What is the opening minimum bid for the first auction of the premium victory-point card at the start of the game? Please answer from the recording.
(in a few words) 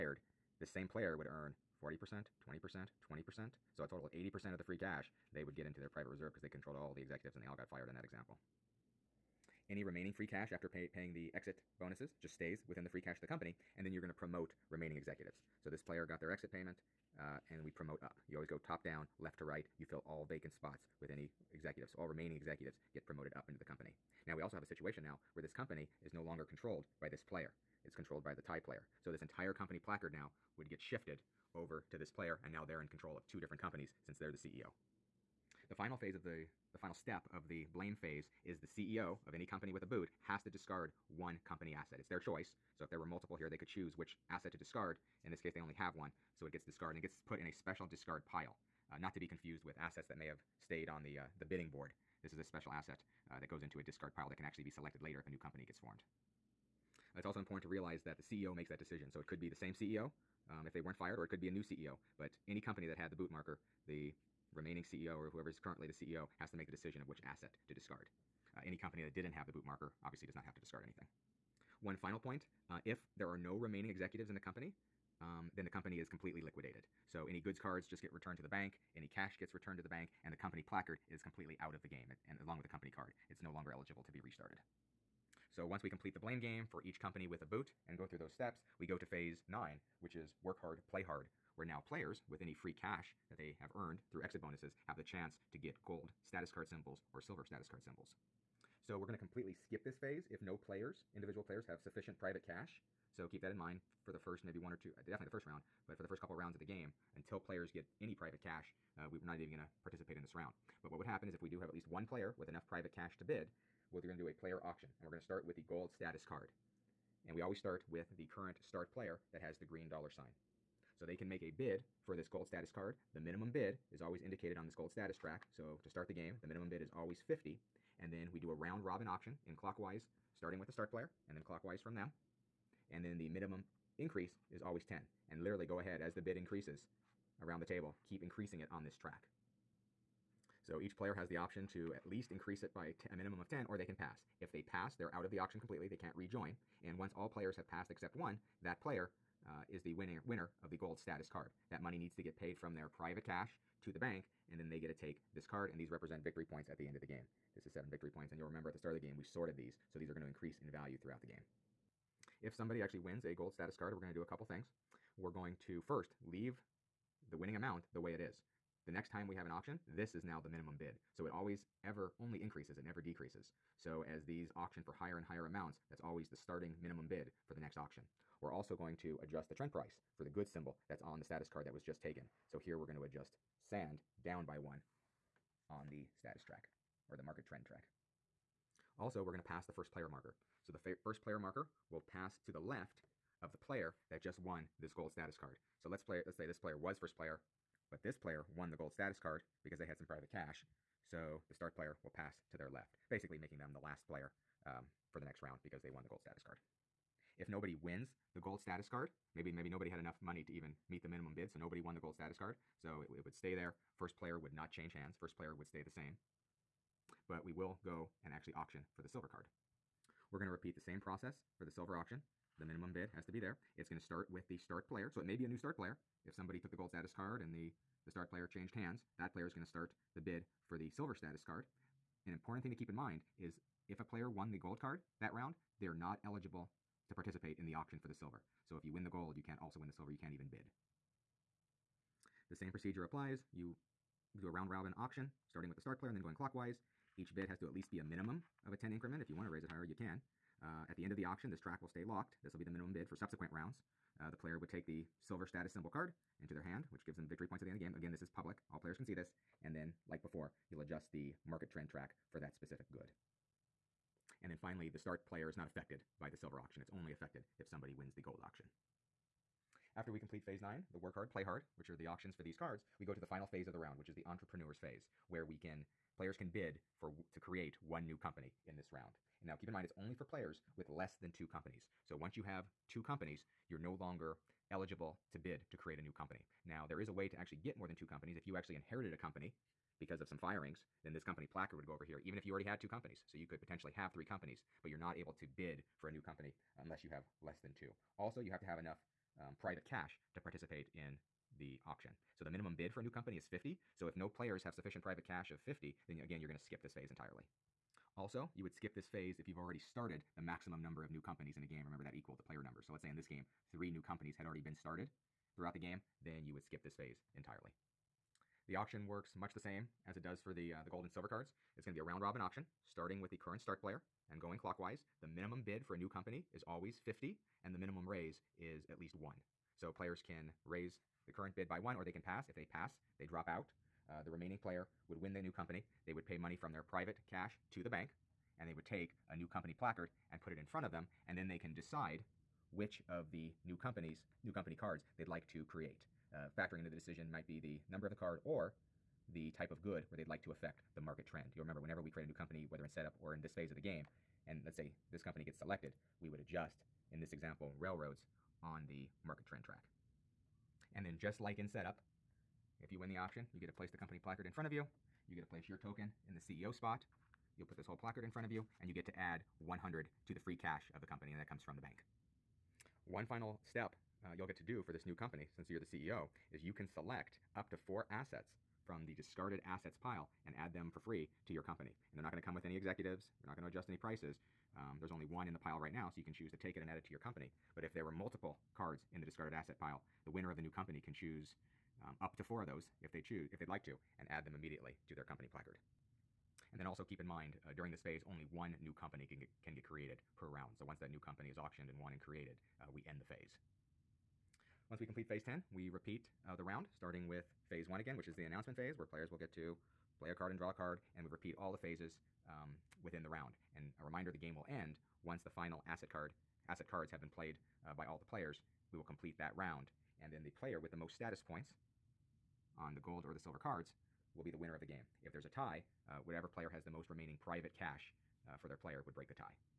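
50.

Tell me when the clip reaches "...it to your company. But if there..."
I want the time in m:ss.
6:26.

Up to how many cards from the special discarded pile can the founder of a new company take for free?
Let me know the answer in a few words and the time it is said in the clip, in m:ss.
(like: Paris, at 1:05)
4, at 6:17.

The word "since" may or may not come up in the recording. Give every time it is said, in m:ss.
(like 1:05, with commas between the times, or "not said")
0:34, 6:15.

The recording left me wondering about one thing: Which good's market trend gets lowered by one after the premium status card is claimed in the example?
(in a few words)
Sand.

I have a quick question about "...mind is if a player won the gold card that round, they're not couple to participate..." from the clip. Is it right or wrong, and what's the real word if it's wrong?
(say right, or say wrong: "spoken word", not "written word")
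wrong: "eligible", not "couple".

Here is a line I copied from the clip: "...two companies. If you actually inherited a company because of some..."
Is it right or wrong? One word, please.
right.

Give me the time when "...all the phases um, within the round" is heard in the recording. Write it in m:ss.
6:51.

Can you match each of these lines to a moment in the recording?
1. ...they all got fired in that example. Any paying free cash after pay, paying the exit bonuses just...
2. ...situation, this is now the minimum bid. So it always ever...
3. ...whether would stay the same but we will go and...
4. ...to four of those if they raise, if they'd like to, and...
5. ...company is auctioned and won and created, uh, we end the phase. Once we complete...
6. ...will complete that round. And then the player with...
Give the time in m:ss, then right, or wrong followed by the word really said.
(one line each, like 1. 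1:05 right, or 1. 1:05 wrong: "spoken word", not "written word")
1. 0:07 wrong: "remaining", not "paying"
2. 2:49 wrong: "auction", not "situation"
3. 3:35 wrong: "player", not "whether"
4. 6:32 wrong: "choose", not "raise"
5. 6:41 right
6. 6:58 right.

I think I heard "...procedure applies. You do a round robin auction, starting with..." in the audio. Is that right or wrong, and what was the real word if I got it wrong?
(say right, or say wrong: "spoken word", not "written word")
right.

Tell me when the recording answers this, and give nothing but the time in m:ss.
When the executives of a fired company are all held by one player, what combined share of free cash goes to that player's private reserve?
0:03.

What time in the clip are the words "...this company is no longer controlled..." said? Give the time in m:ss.
0:25.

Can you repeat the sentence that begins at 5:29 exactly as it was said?
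So players can raise the current bid by one, or they can pass.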